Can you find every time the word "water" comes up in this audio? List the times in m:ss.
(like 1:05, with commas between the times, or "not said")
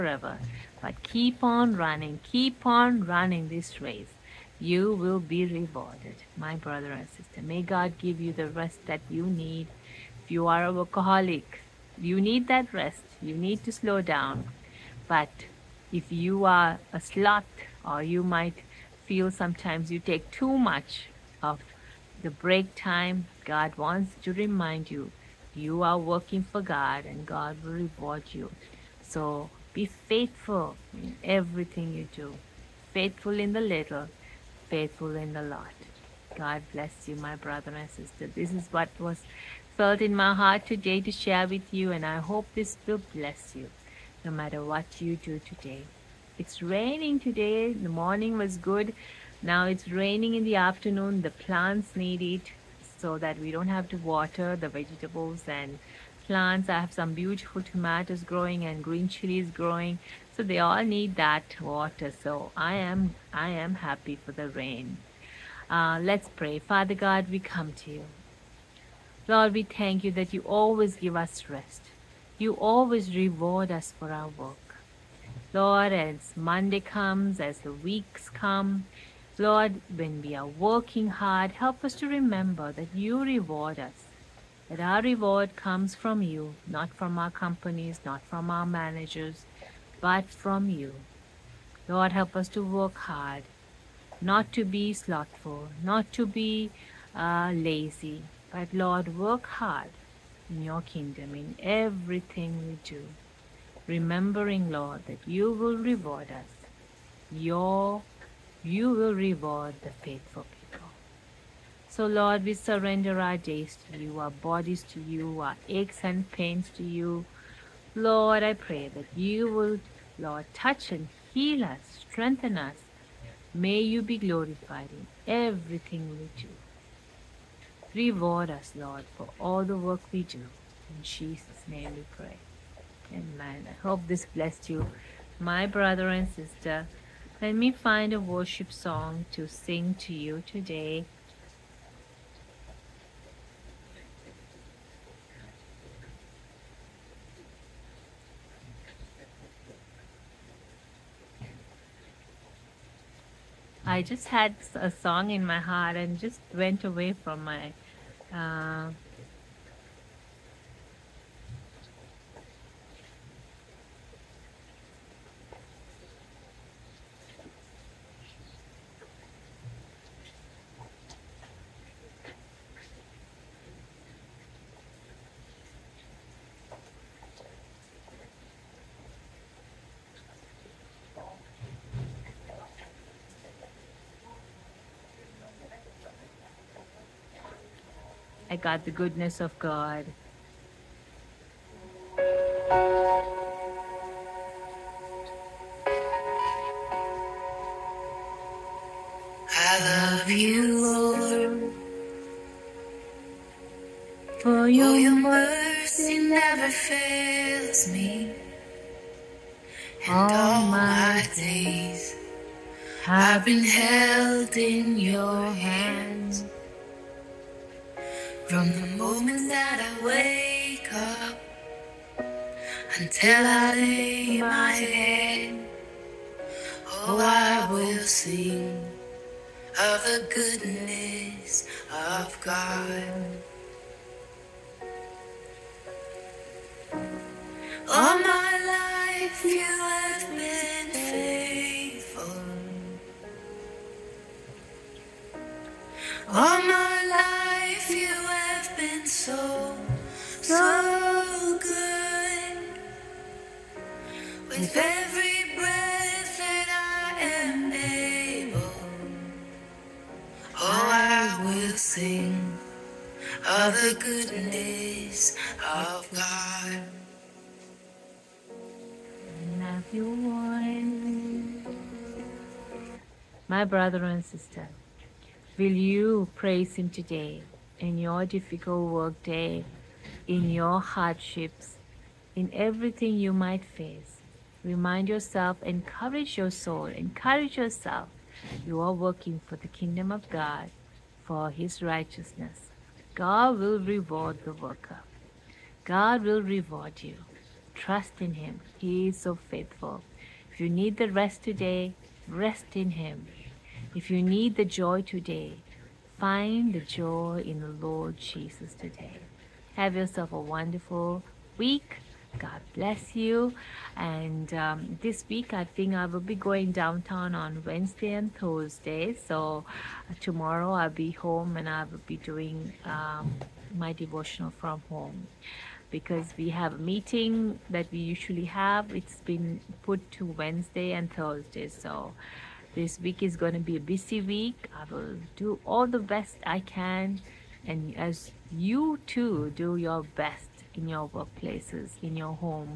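0:53, 1:01.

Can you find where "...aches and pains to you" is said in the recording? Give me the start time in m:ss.
1:55.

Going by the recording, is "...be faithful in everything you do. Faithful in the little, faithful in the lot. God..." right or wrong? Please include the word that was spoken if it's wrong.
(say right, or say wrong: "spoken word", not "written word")
right.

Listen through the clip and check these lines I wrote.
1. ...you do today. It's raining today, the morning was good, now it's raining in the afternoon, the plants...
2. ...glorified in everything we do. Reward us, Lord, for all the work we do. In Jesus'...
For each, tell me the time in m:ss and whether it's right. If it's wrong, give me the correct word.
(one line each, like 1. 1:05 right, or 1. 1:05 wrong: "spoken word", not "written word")
1. 0:45 right
2. 2:04 right.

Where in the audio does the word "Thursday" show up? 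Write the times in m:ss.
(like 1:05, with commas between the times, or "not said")
5:18, 5:31.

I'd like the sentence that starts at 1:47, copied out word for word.
Your, you will reward the faithful people.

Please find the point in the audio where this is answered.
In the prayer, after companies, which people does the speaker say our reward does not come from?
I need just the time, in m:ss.
1:28.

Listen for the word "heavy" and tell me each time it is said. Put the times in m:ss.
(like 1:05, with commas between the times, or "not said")
not said.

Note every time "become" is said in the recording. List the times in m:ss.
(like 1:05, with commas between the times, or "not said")
not said.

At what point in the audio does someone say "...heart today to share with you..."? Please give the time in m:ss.
0:40.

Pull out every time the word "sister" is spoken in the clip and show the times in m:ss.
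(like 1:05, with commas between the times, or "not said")
0:07, 0:37, 2:16, 4:34.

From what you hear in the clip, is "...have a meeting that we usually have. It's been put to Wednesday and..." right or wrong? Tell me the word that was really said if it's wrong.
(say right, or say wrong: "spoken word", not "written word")
right.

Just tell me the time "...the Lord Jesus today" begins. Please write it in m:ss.
5:07.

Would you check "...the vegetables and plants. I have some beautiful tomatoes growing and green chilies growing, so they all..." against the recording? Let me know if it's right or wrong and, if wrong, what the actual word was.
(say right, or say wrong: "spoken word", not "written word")
right.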